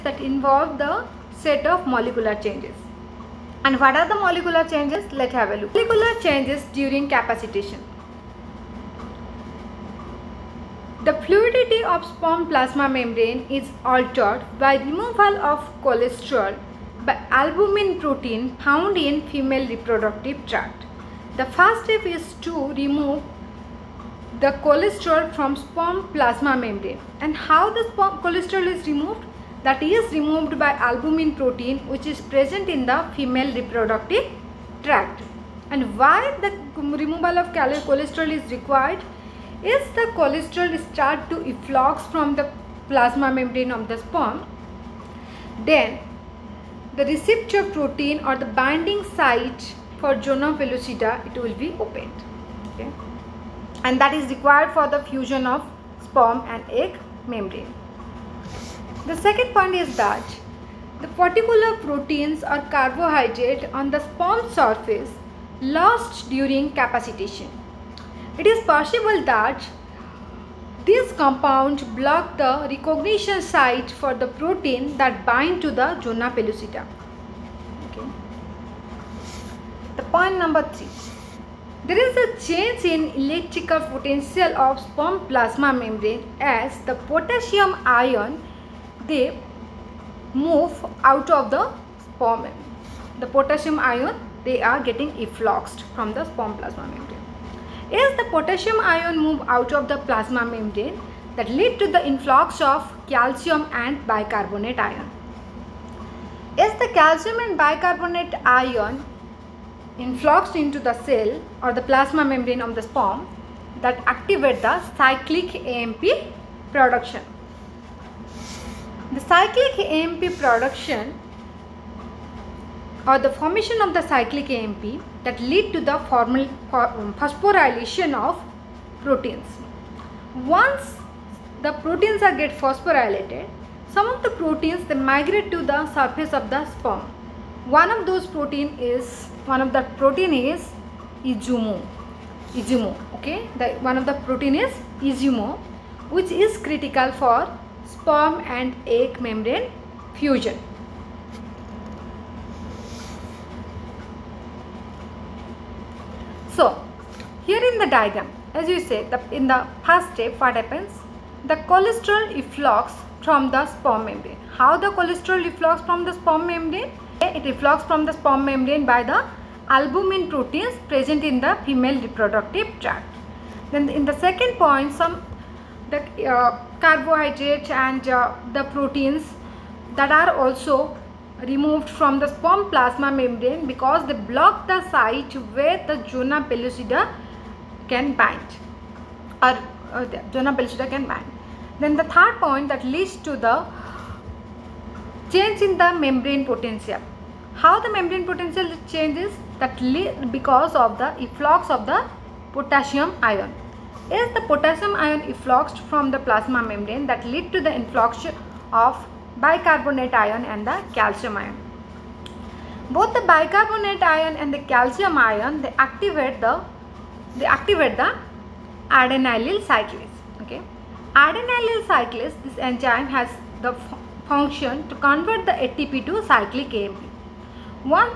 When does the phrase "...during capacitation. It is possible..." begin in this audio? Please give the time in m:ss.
1:06.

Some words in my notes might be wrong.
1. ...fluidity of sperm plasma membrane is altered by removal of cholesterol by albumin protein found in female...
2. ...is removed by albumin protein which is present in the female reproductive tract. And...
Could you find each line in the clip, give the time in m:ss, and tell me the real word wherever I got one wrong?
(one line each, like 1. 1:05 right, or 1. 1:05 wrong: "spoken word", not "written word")
1. 0:11 right
2. 0:29 right.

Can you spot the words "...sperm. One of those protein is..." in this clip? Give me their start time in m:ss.
2:16.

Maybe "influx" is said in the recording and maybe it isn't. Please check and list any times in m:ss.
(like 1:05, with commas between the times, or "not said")
1:42, 1:49, 3:27.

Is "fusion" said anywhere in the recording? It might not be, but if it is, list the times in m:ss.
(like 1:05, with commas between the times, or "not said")
0:55, 2:30.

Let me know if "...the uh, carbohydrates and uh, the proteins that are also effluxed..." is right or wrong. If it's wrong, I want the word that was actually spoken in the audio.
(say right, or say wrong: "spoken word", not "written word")
wrong: "removed", not "effluxed".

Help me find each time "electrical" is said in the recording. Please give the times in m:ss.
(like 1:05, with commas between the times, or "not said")
1:23.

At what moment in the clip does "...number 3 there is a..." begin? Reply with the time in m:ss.
1:20.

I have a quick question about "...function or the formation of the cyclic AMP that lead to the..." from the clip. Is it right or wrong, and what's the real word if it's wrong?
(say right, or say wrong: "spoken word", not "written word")
wrong: "production", not "function".